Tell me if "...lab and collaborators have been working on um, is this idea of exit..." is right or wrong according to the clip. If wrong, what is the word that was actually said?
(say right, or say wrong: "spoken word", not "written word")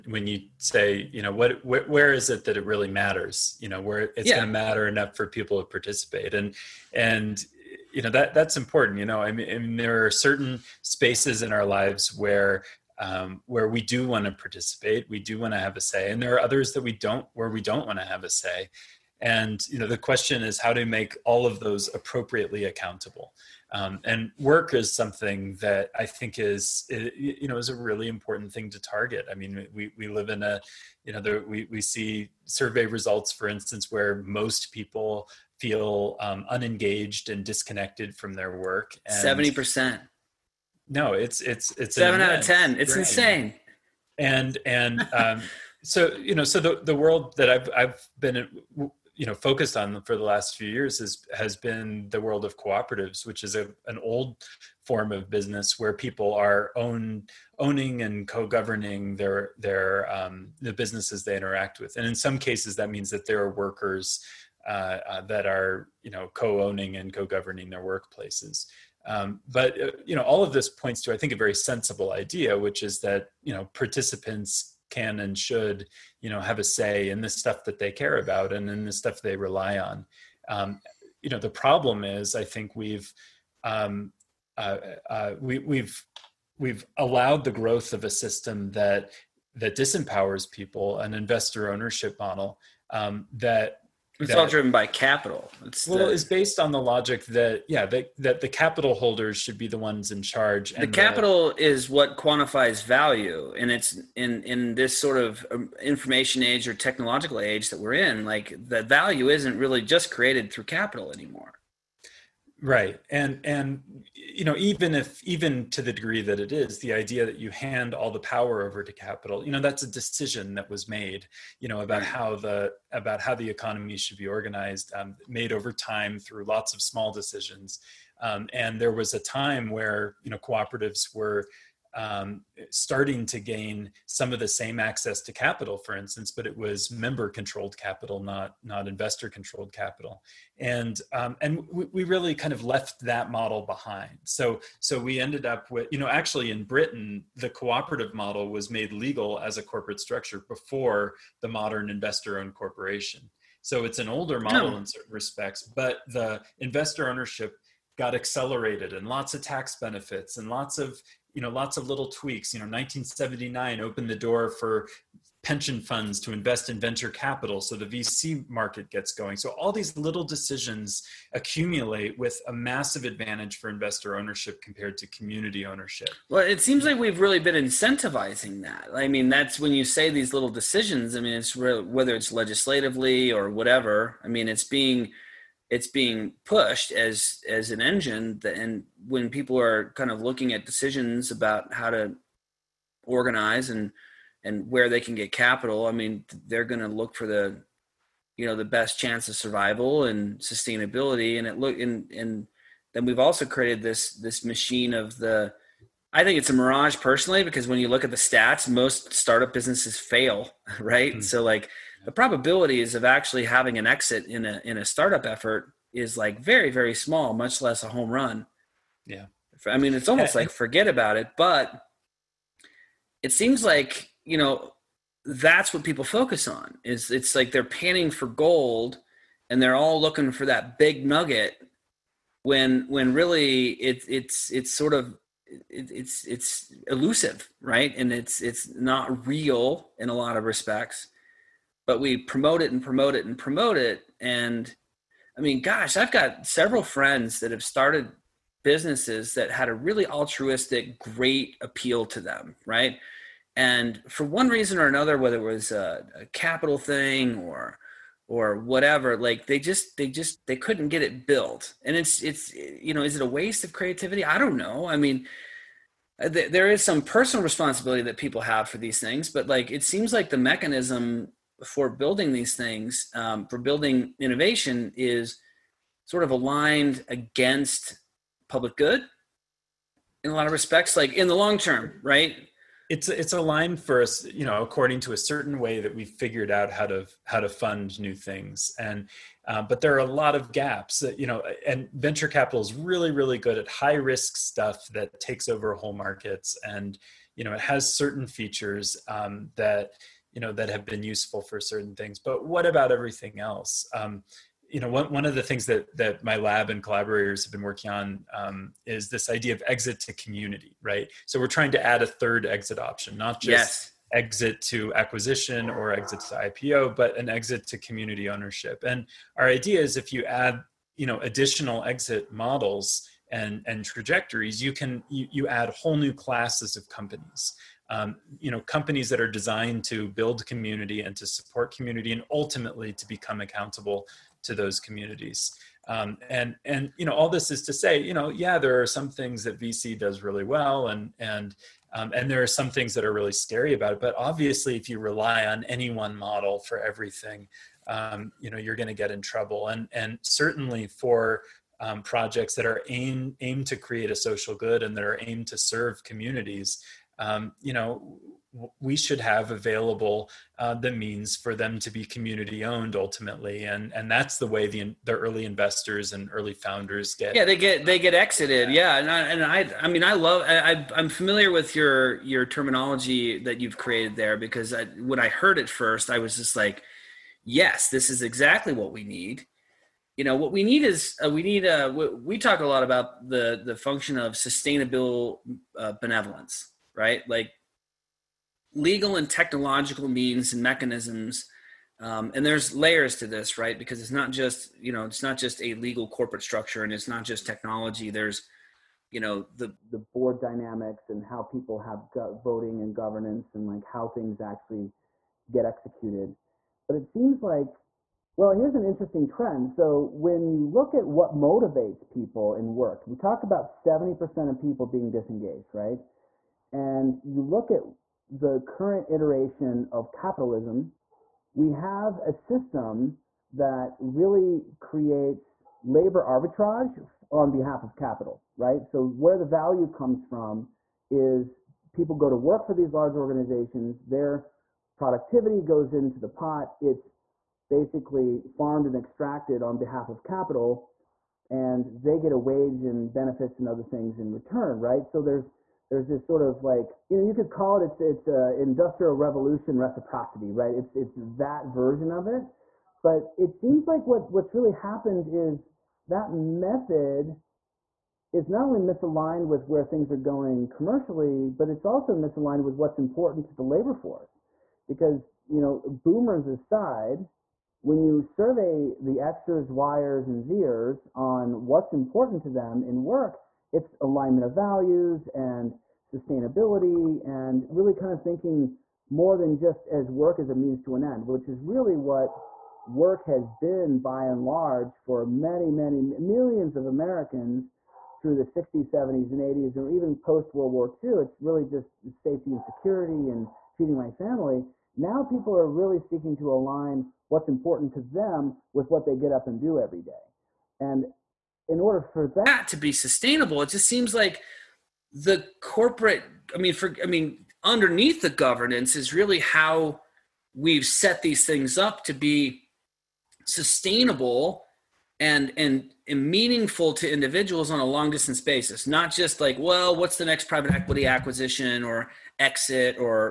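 right.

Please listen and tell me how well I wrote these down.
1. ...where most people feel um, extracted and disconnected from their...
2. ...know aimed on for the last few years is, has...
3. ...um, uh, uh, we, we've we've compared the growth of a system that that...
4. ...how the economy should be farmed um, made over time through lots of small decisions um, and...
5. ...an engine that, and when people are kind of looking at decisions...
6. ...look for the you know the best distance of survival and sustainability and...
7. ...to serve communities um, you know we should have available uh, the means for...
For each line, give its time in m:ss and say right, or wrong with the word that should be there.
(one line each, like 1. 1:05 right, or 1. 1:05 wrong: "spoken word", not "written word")
1. 0:33 wrong: "unengaged", not "extracted"
2. 0:49 wrong: "focused", not "aimed"
3. 1:23 wrong: "allowed", not "compared"
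4. 2:03 wrong: "organized", not "farmed"
5. 3:07 right
6. 3:16 wrong: "chance", not "distance"
7. 5:55 right.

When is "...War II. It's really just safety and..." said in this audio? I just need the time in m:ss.
8:10.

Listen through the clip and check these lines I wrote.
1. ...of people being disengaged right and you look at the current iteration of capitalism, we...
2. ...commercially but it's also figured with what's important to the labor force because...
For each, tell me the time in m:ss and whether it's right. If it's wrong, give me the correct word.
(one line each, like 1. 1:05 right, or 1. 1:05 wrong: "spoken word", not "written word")
1. 6:54 right
2. 7:40 wrong: "misaligned", not "figured".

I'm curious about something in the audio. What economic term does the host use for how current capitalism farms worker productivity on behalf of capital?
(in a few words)
labor arbitrage.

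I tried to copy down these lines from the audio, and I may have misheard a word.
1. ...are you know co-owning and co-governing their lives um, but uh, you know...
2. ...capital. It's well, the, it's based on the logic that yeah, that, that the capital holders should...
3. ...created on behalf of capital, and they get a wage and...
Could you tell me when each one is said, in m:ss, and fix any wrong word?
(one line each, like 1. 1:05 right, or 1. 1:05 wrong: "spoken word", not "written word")
1. 1:05 wrong: "workplaces", not "lives"
2. 1:34 right
3. 7:18 wrong: "extracted", not "created".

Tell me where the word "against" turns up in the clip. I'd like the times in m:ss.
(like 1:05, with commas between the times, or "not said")
4:37.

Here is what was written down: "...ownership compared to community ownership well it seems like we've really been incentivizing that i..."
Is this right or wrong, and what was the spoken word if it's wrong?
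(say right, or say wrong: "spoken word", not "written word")
right.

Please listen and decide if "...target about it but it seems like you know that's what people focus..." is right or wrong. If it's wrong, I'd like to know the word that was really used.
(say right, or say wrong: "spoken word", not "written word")
wrong: "forget", not "target".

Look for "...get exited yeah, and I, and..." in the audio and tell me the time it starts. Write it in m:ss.
6:07.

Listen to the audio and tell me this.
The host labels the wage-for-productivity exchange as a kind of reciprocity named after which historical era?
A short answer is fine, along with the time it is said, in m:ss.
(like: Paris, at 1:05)
industrial revolution, at 7:28.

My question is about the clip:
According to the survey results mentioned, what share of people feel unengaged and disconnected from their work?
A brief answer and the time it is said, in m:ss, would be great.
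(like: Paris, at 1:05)
7 out of 10, at 0:41.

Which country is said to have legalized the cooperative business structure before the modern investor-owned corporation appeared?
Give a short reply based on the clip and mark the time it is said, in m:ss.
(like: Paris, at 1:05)
Britain, at 2:26.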